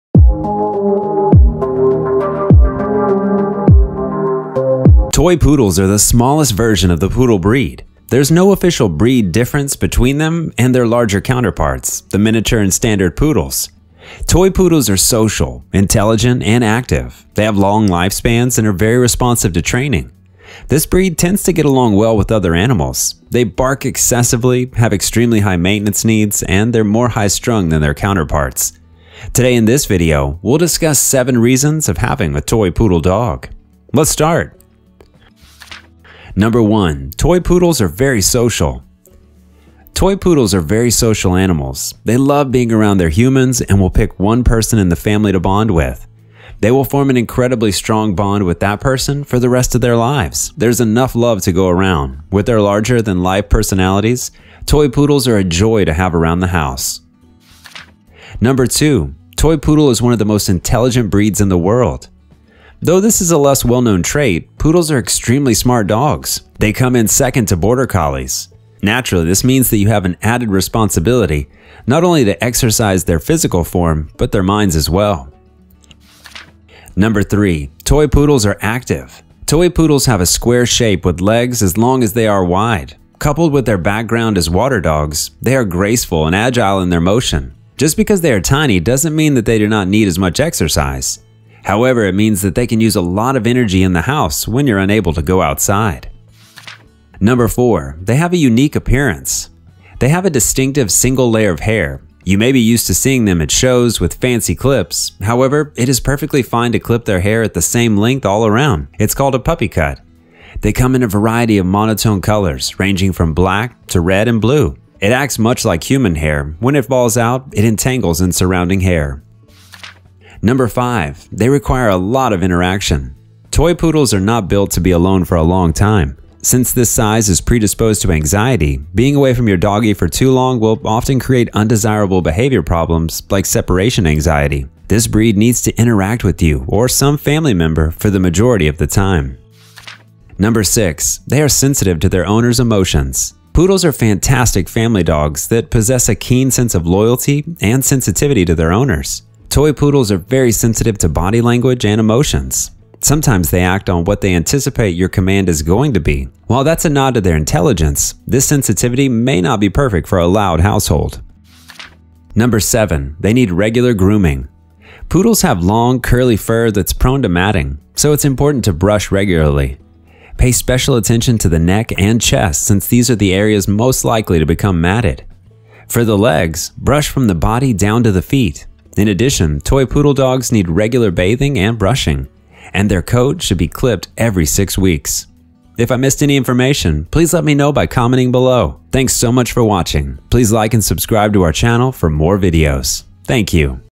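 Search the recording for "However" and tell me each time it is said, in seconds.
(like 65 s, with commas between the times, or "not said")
91 s, 105 s.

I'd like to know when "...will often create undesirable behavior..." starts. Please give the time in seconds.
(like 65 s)
130 s.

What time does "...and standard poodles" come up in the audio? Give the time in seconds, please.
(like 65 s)
12 s.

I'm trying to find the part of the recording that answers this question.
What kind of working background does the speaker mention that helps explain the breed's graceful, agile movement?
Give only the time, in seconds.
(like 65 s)
84 s.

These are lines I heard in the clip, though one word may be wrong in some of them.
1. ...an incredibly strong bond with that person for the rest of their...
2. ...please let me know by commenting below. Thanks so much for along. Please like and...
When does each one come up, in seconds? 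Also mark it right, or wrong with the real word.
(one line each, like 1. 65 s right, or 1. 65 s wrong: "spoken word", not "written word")
1. 47 s right
2. 187 s wrong: "watching", not "along".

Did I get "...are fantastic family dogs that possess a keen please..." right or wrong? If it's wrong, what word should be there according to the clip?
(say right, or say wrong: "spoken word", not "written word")
wrong: "sense", not "please".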